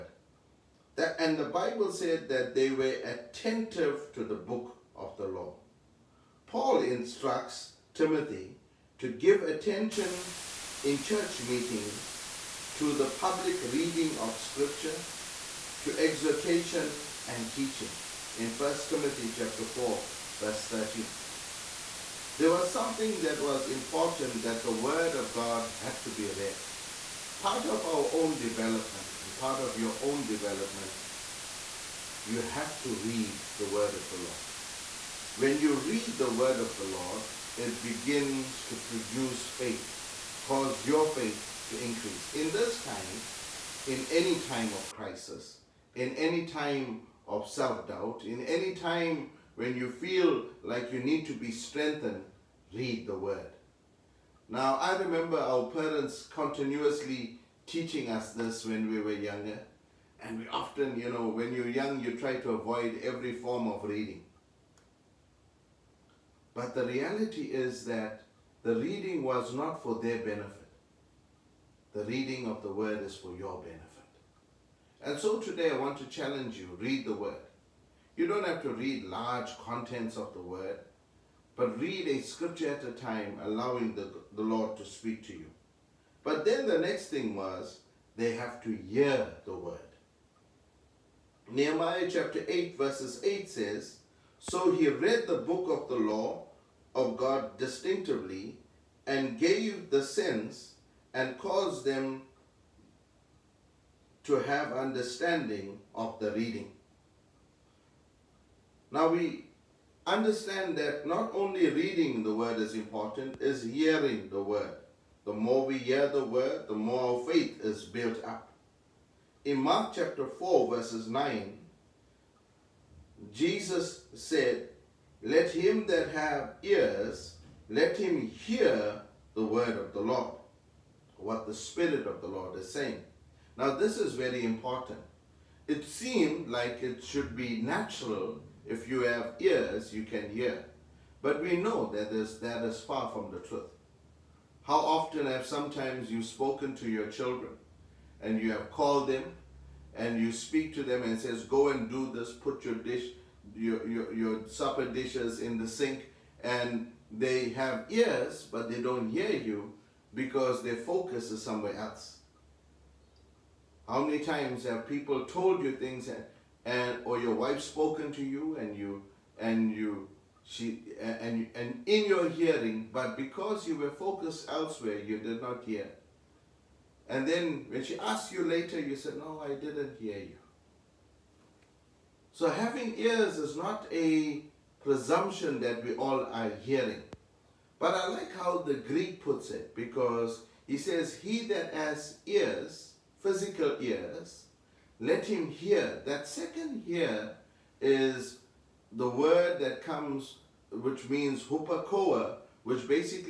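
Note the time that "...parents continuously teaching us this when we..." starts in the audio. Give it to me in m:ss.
0:55.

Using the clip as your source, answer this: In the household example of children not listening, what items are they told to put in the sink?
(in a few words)
Supper dishes.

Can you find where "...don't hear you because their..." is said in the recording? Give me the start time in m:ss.
2:38.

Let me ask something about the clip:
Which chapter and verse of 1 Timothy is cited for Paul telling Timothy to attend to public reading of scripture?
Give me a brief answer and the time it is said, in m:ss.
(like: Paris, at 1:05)
Chapter 4 verse 13, at 0:19.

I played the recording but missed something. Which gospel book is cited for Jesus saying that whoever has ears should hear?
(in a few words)
Mark.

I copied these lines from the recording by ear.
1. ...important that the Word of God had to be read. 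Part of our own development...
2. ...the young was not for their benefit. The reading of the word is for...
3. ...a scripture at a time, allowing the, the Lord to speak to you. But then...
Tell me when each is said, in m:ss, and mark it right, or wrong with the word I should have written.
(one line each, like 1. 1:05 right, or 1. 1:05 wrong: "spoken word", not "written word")
1. 0:23 right
2. 1:08 wrong: "reading", not "young"
3. 1:22 right.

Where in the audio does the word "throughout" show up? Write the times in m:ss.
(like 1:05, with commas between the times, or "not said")
not said.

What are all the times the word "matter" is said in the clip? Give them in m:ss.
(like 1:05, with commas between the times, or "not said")
not said.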